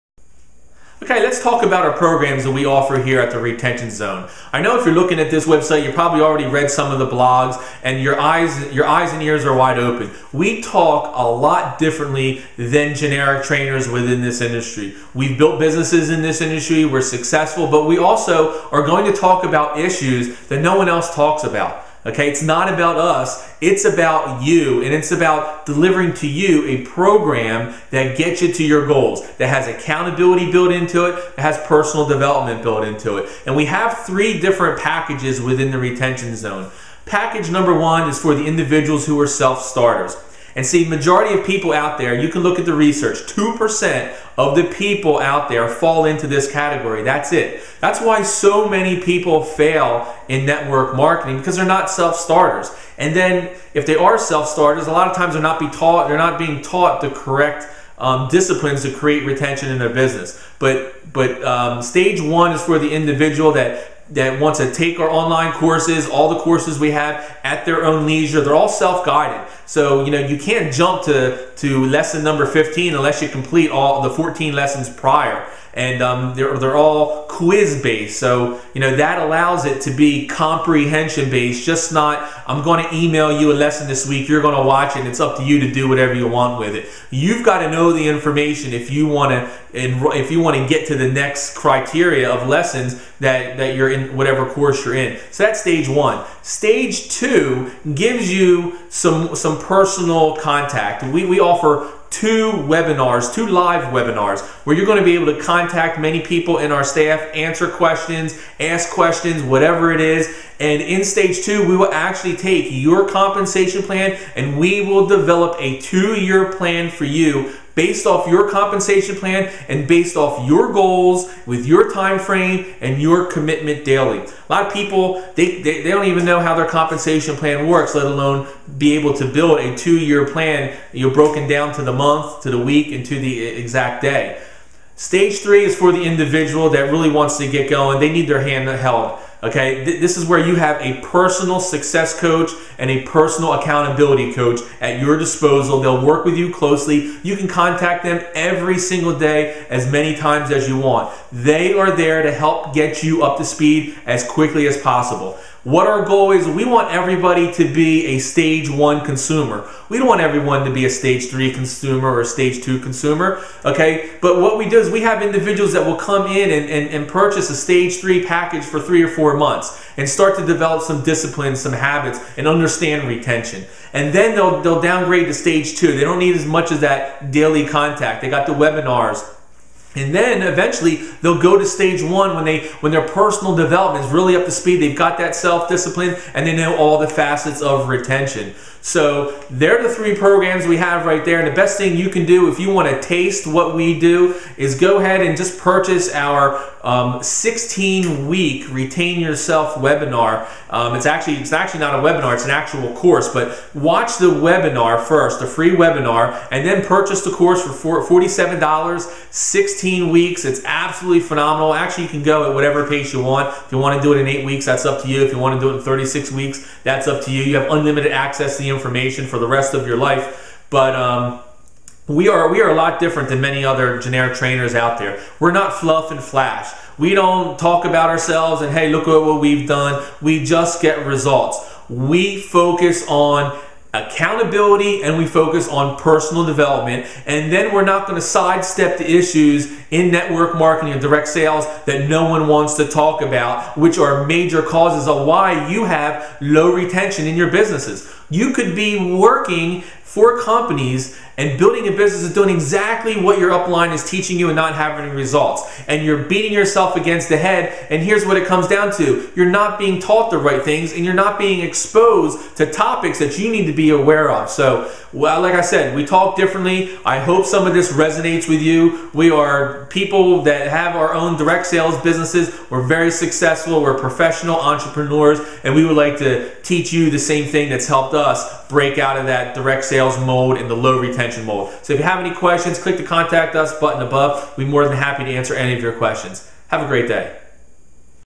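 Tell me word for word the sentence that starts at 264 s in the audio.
So, well, like I said, we talk differently.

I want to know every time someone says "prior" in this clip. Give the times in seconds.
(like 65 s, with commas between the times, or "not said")
74 s.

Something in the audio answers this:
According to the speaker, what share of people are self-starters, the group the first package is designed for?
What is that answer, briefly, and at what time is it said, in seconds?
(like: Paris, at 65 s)
2%, at 43 s.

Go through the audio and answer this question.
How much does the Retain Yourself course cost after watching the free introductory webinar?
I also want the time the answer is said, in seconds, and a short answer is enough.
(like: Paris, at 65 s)
$47, at 208 s.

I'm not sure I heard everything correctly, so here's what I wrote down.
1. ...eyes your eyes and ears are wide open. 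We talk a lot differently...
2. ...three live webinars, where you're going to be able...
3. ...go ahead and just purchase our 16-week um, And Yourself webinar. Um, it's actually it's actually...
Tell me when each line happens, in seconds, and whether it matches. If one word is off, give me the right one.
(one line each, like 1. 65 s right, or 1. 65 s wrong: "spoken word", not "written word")
1. 8 s right
2. 103 s wrong: "two", not "three"
3. 194 s wrong: "Retain", not "And".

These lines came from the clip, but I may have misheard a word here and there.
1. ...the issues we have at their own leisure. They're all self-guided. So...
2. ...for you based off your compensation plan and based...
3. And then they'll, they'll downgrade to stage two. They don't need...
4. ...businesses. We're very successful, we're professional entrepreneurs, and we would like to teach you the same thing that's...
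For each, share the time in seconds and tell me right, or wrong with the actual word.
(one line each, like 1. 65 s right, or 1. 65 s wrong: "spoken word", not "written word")
1. 66 s wrong: "courses", not "issues"
2. 116 s right
3. 173 s right
4. 272 s right.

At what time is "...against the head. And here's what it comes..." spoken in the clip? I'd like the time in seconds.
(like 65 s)
256 s.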